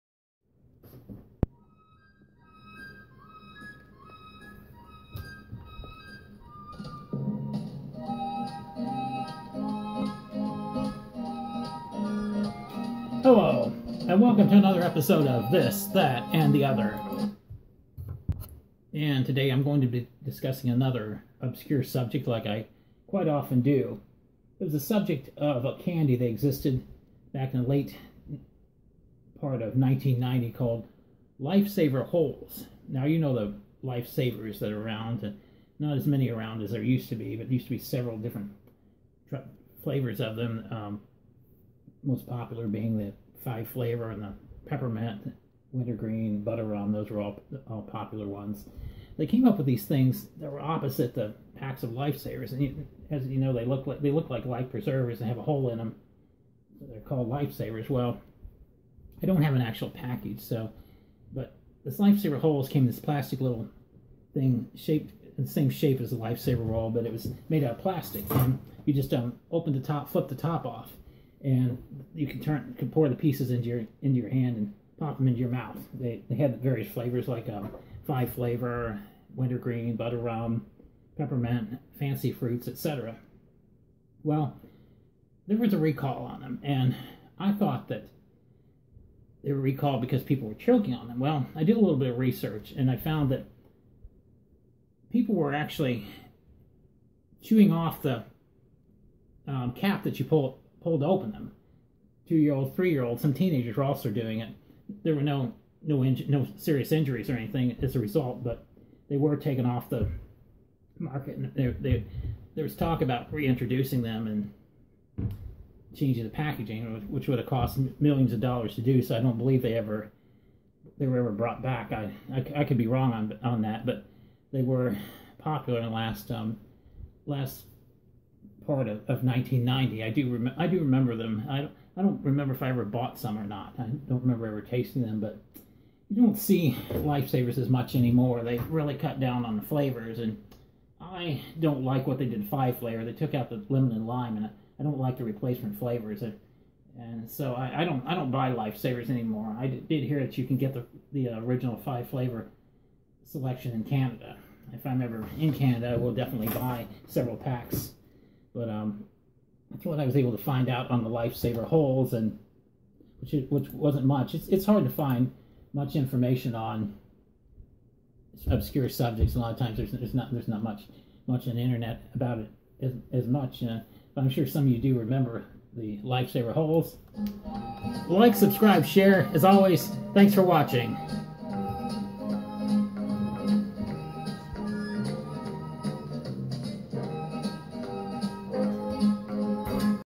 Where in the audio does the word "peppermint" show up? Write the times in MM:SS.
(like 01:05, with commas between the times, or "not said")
00:44, 01:21.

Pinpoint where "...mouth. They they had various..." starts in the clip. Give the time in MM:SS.
01:15.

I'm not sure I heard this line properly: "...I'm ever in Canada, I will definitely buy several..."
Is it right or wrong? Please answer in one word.
right.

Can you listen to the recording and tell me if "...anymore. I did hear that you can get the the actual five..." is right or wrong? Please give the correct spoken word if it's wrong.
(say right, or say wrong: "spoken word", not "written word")
wrong: "original", not "actual".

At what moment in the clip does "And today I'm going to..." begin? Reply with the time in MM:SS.
00:18.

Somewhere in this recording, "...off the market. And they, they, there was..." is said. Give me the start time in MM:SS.
01:49.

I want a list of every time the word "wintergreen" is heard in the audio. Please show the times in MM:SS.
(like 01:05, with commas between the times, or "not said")
00:45, 01:19.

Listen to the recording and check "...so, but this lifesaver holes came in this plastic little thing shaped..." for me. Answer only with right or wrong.
right.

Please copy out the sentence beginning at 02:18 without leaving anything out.
They really cut down on the flavors, and I don't like what they did five flavor.